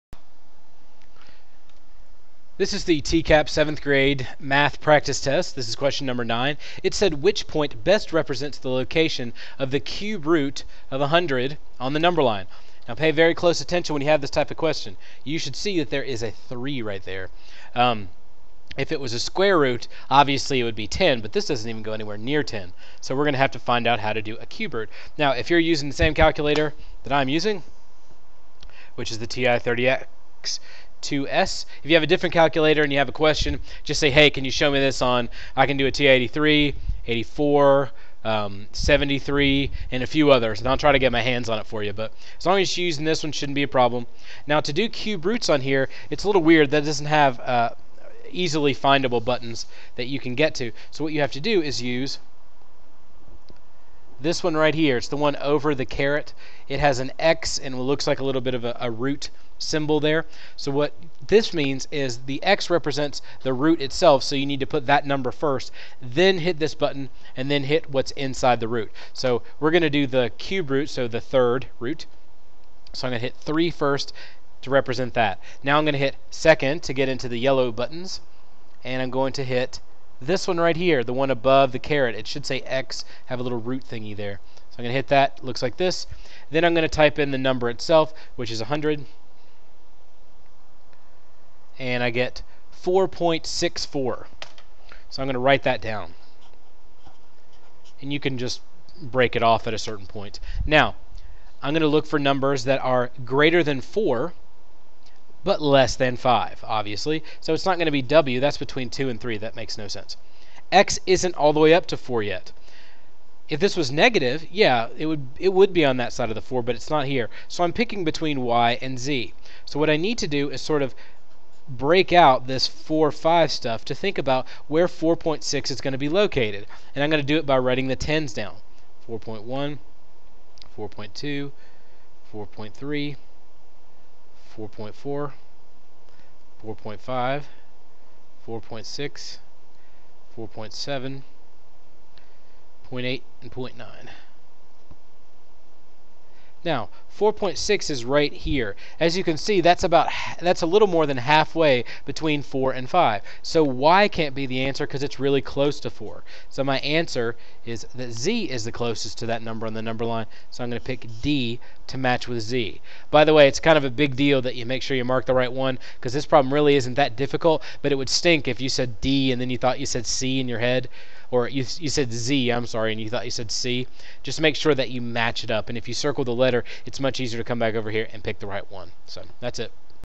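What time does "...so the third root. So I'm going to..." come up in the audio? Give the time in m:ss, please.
1:10.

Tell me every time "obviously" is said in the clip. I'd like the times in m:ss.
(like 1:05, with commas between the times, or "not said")
0:20, 1:46.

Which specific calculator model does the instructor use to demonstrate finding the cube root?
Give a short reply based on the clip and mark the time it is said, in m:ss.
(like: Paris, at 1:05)
TI-30X 2S, at 0:29.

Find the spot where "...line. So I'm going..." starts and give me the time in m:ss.
2:40.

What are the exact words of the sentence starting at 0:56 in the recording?
It has an X and looks like a little bit of a, a root symbol there.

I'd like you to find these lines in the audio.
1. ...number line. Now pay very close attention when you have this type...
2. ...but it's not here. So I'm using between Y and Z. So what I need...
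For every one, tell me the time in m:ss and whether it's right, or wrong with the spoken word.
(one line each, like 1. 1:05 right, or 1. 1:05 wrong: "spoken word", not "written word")
1. 0:11 right
2. 1:56 wrong: "picking", not "using".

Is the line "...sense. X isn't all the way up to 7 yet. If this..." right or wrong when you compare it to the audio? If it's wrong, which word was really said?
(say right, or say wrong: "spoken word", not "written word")
wrong: "4", not "7".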